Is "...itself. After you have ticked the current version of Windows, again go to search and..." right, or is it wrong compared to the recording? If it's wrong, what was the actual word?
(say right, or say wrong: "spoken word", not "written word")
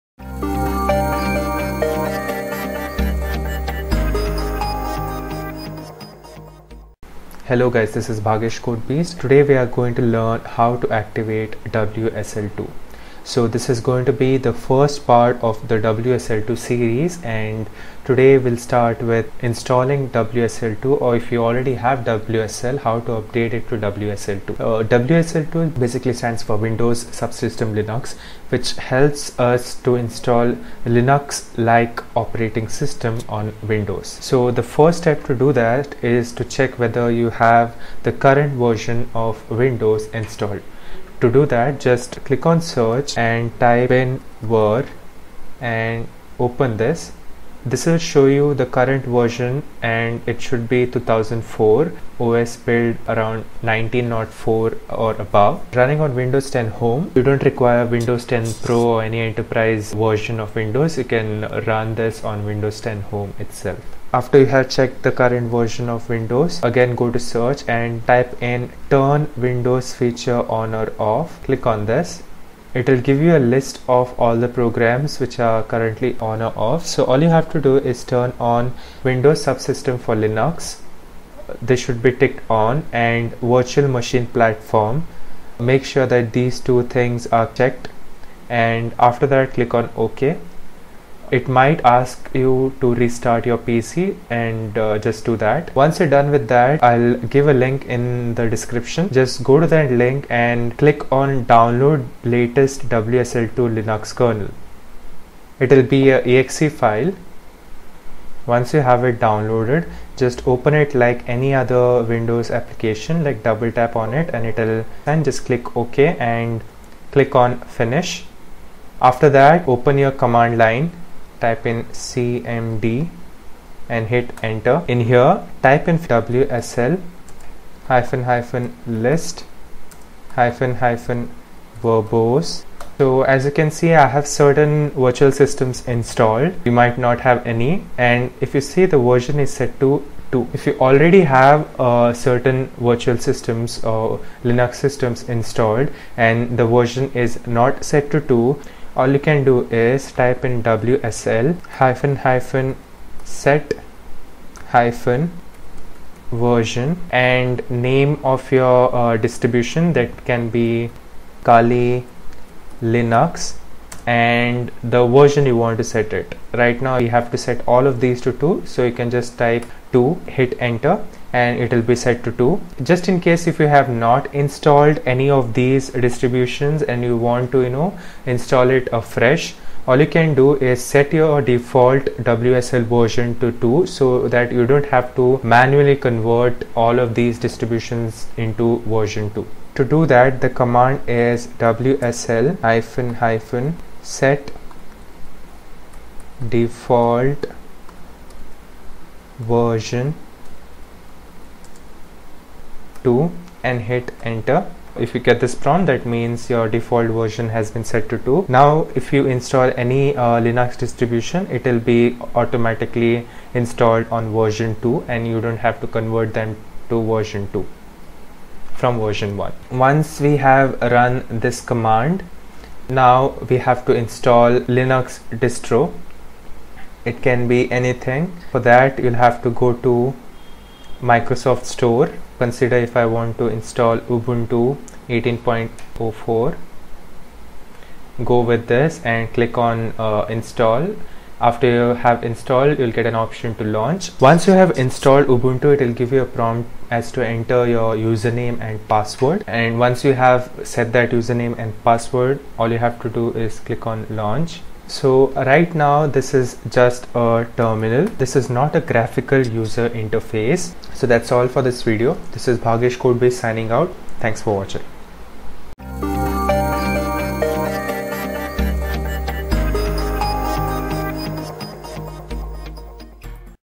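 wrong: "checked", not "ticked".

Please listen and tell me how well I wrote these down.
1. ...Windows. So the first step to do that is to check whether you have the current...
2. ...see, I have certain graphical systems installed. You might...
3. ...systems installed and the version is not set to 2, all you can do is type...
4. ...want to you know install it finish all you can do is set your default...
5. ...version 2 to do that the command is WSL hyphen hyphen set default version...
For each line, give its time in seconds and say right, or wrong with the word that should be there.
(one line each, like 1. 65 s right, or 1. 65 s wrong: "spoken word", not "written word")
1. 33 s right
2. 133 s wrong: "virtual", not "graphical"
3. 144 s right
4. 177 s wrong: "afresh", not "finish"
5. 188 s right.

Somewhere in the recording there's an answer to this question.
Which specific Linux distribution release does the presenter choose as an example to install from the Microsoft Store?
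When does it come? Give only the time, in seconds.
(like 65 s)
233 s.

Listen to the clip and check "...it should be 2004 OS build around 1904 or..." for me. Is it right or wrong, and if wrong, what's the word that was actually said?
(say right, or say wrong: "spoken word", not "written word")
right.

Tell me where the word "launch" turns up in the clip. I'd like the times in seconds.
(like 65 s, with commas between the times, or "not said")
243 s, 254 s.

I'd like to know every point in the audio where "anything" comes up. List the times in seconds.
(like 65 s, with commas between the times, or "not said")
227 s.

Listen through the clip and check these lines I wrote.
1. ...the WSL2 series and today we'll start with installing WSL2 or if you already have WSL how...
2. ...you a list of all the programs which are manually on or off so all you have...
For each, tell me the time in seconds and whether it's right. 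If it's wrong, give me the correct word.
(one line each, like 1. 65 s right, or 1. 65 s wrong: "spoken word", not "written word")
1. 15 s right
2. 73 s wrong: "currently", not "manually".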